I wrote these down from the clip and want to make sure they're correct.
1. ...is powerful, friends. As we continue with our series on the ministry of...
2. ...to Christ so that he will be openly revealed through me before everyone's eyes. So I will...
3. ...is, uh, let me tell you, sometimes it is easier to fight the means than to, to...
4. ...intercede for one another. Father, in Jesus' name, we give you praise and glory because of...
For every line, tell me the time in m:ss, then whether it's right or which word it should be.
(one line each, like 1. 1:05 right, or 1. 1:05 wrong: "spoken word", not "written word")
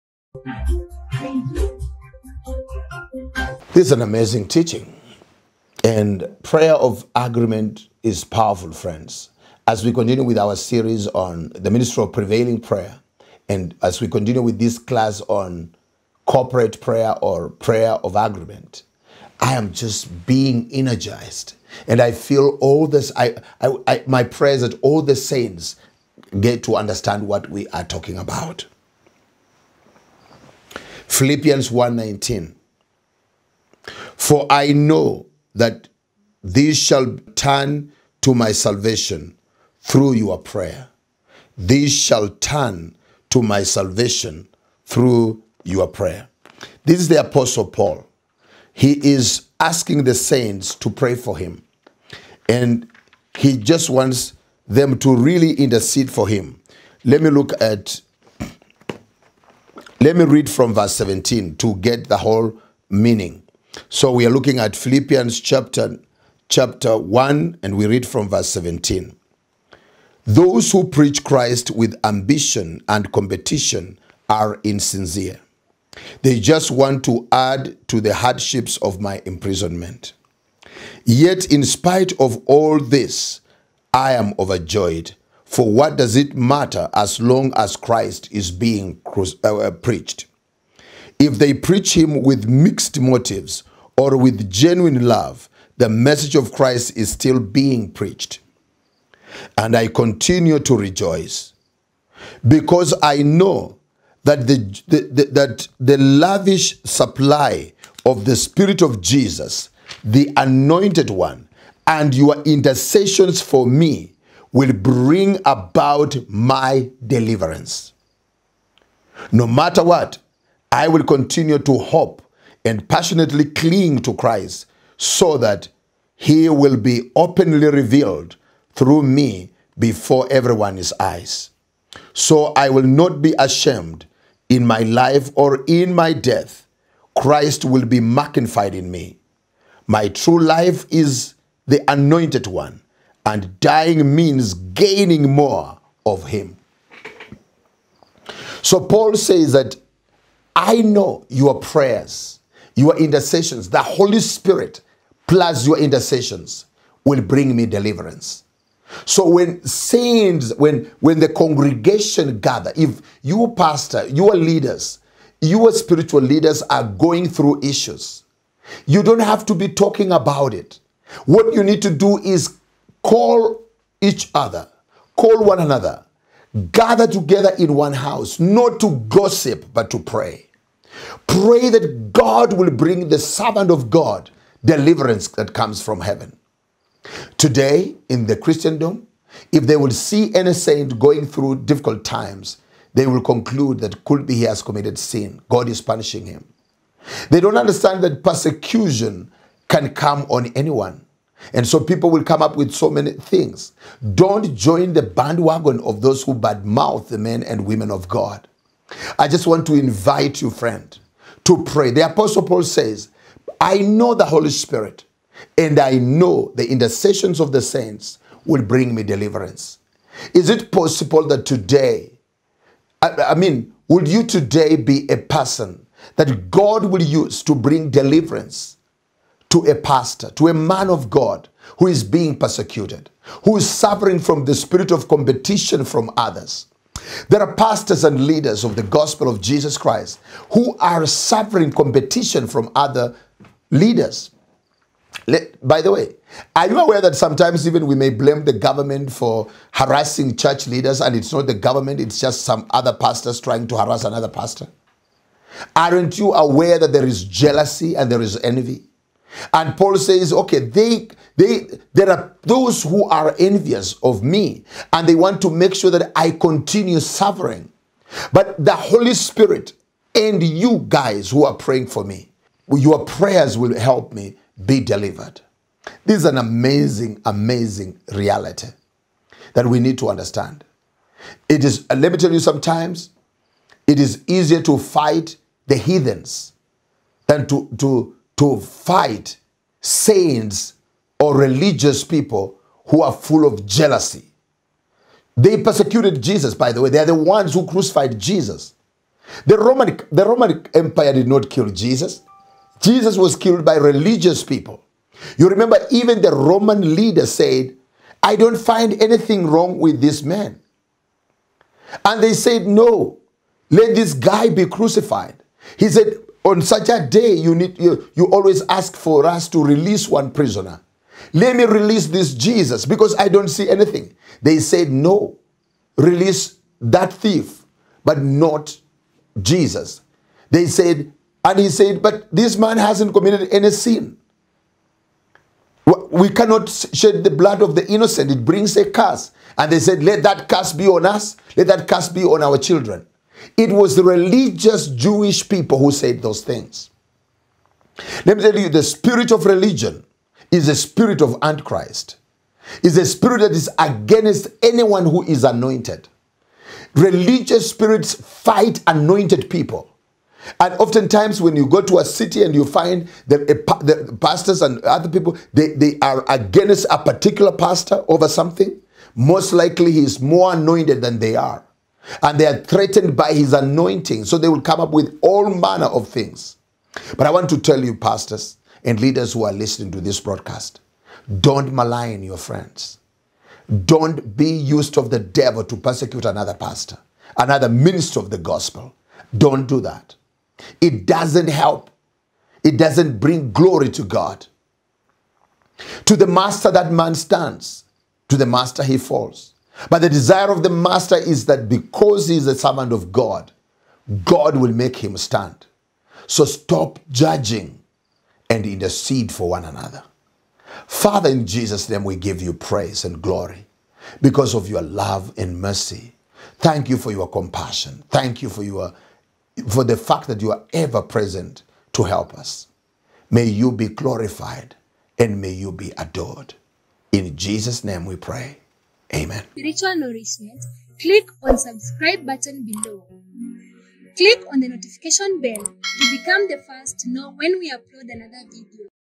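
1. 0:08 right
2. 2:03 right
3. 4:41 wrong: "heathens", not "means"
4. 6:48 right.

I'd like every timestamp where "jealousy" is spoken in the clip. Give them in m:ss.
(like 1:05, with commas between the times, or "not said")
4:17, 4:53.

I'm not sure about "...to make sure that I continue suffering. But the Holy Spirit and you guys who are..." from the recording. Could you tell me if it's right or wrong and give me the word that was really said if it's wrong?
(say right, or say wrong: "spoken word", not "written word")
right.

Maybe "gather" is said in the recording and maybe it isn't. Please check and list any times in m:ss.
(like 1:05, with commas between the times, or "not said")
2:42, 2:56.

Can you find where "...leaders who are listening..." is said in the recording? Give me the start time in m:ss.
6:18.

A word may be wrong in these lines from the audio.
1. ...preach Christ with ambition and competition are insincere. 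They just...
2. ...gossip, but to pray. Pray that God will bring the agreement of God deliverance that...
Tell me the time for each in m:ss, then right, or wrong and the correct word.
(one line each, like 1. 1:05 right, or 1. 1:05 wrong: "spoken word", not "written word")
1. 1:10 right
2. 2:59 wrong: "servant", not "agreement".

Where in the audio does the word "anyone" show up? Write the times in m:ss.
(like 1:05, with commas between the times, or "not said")
3:20, 5:54.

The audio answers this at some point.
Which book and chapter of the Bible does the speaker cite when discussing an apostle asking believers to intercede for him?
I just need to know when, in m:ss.
1:04.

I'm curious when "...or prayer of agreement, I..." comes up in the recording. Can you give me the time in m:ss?
0:17.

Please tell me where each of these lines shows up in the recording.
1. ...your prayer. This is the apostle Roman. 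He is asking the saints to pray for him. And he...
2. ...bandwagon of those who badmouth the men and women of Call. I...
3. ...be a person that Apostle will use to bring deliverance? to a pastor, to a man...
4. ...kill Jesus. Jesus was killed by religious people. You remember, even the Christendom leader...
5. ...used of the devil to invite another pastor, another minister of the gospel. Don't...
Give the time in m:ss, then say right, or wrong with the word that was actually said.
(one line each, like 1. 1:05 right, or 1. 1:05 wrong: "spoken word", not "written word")
1. 0:45 wrong: "Paul", not "Roman"
2. 3:25 wrong: "God", not "Call"
3. 3:44 wrong: "God", not "Apostle"
4. 5:01 wrong: "Roman", not "Christendom"
5. 6:24 wrong: "persecute", not "invite".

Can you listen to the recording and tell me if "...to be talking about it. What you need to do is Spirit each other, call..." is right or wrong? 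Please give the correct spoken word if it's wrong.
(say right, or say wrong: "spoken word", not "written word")
wrong: "Call", not "Spirit".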